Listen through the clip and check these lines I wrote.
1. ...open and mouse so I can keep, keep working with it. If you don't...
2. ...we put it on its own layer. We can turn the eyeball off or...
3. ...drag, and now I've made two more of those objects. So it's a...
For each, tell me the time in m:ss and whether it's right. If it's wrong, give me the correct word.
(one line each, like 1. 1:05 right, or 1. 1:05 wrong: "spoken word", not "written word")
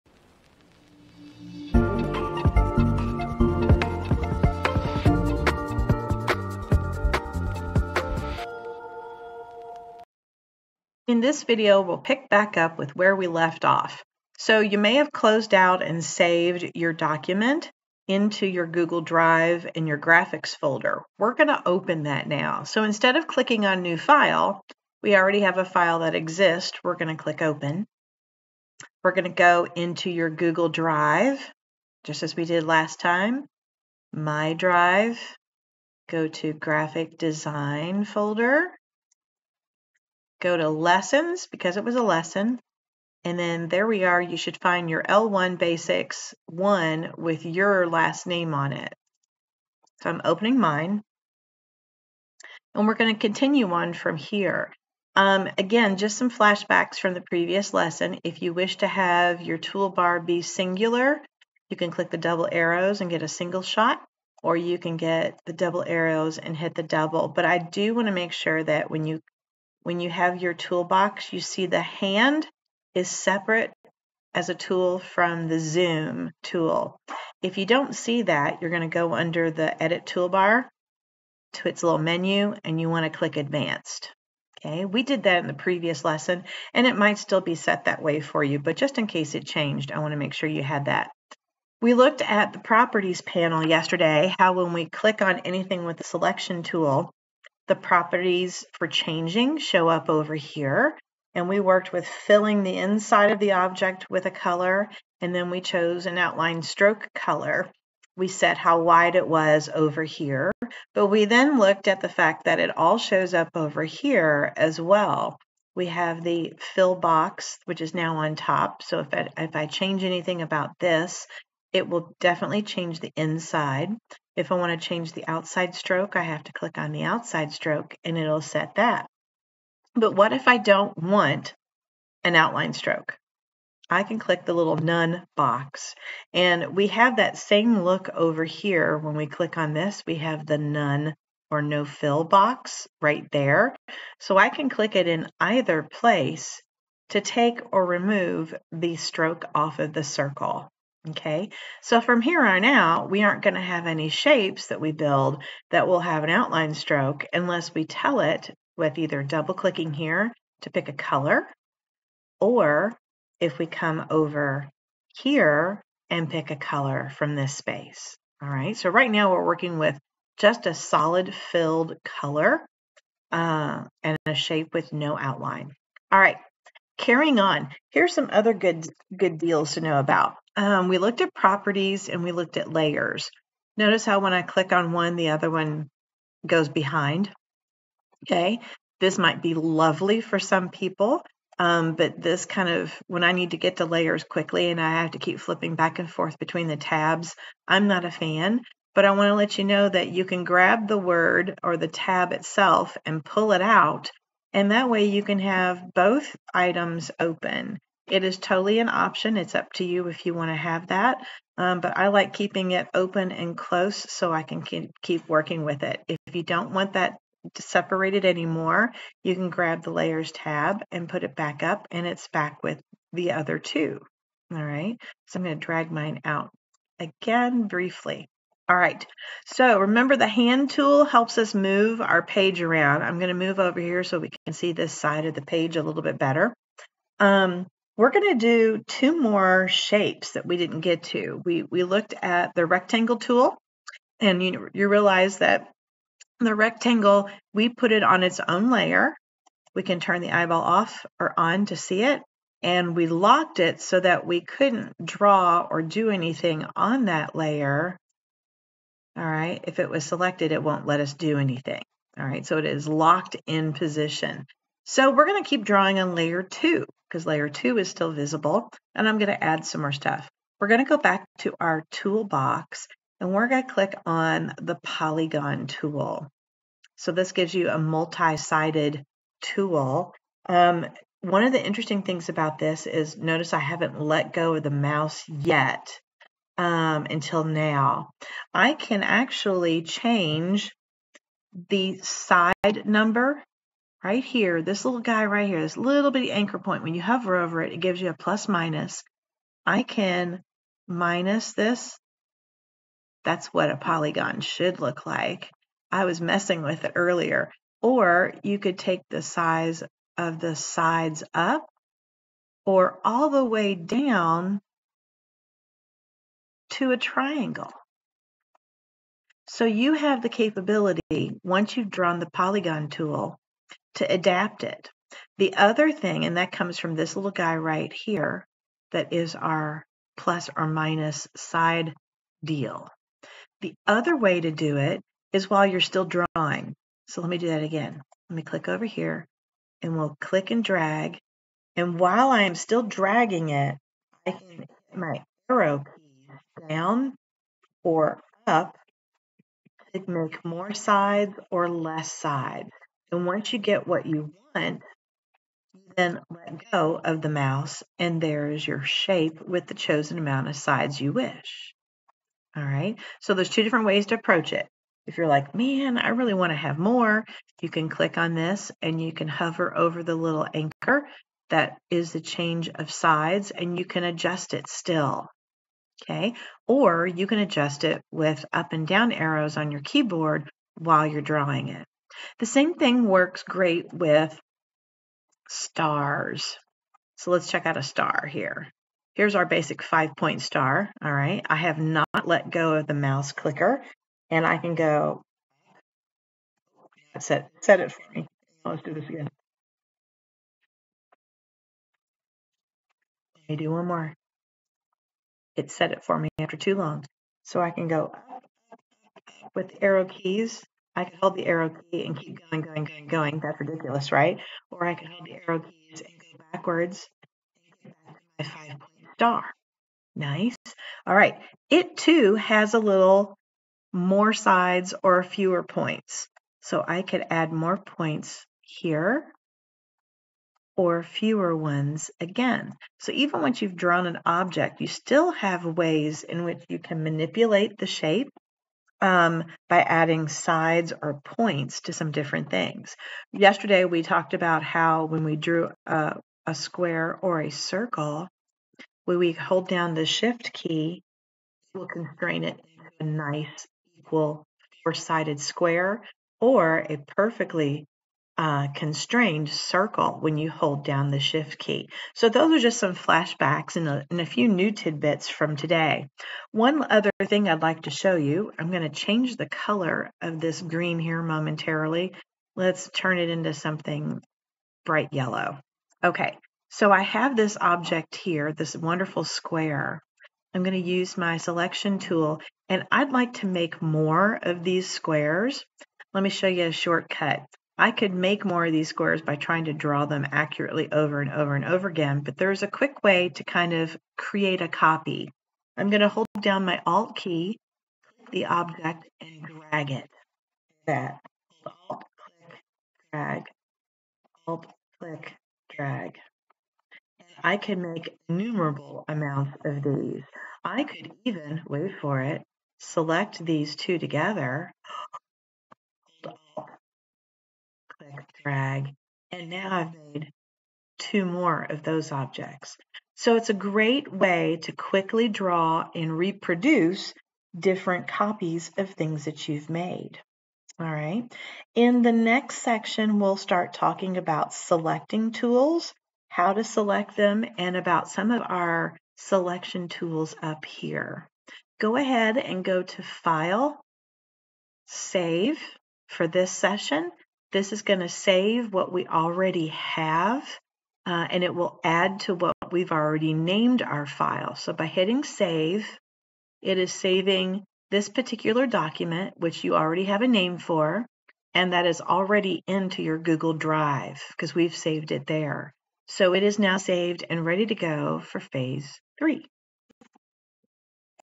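1. 3:32 wrong: "close", not "mouse"
2. 4:07 right
3. 8:38 right.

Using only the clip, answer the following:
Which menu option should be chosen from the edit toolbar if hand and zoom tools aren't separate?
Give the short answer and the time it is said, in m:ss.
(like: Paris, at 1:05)
advanced, at 1:23.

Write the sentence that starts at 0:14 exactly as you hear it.
So you may have closed out and saved your document into your Google Drive and your graphics folder.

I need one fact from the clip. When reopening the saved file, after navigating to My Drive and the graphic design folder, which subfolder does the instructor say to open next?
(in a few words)
lessons.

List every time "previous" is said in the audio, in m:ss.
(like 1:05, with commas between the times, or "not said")
0:57, 1:25.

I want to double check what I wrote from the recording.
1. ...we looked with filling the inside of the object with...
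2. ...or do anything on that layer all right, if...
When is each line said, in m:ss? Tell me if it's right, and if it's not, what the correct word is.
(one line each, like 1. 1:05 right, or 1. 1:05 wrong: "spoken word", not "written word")
1. 1:41 wrong: "worked", not "looked"
2. 4:15 right.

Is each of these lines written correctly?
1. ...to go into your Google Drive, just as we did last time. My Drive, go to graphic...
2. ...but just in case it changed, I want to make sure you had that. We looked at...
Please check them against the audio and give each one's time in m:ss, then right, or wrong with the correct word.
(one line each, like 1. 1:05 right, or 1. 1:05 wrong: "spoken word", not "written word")
1. 0:29 right
2. 1:28 right.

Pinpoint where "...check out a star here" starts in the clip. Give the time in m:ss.
6:27.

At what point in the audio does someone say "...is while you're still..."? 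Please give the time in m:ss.
5:35.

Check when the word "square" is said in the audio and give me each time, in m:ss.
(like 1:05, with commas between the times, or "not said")
7:26, 7:35, 7:59, 8:04, 8:08.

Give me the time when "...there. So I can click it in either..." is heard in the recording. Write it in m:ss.
2:23.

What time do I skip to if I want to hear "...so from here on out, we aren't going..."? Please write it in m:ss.
2:31.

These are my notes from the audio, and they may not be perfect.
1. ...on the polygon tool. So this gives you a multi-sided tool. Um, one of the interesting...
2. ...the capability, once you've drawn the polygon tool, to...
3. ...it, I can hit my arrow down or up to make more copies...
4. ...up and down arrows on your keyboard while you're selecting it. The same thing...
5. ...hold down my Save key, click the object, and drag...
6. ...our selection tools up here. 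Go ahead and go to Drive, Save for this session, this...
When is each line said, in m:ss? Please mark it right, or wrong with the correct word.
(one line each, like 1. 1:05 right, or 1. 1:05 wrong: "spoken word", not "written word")
1. 4:34 right
2. 5:20 right
3. 5:43 wrong: "sides", not "copies"
4. 6:18 wrong: "drawing", not "selecting"
5. 8:16 wrong: "Alt", not "Save"
6. 8:58 wrong: "File", not "Drive".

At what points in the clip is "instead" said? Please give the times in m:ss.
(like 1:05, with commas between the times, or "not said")
0:22.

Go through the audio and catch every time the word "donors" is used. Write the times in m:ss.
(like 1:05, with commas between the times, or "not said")
not said.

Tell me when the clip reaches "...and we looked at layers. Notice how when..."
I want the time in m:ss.
3:02.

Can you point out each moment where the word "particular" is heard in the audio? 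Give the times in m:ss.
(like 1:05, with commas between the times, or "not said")
9:18.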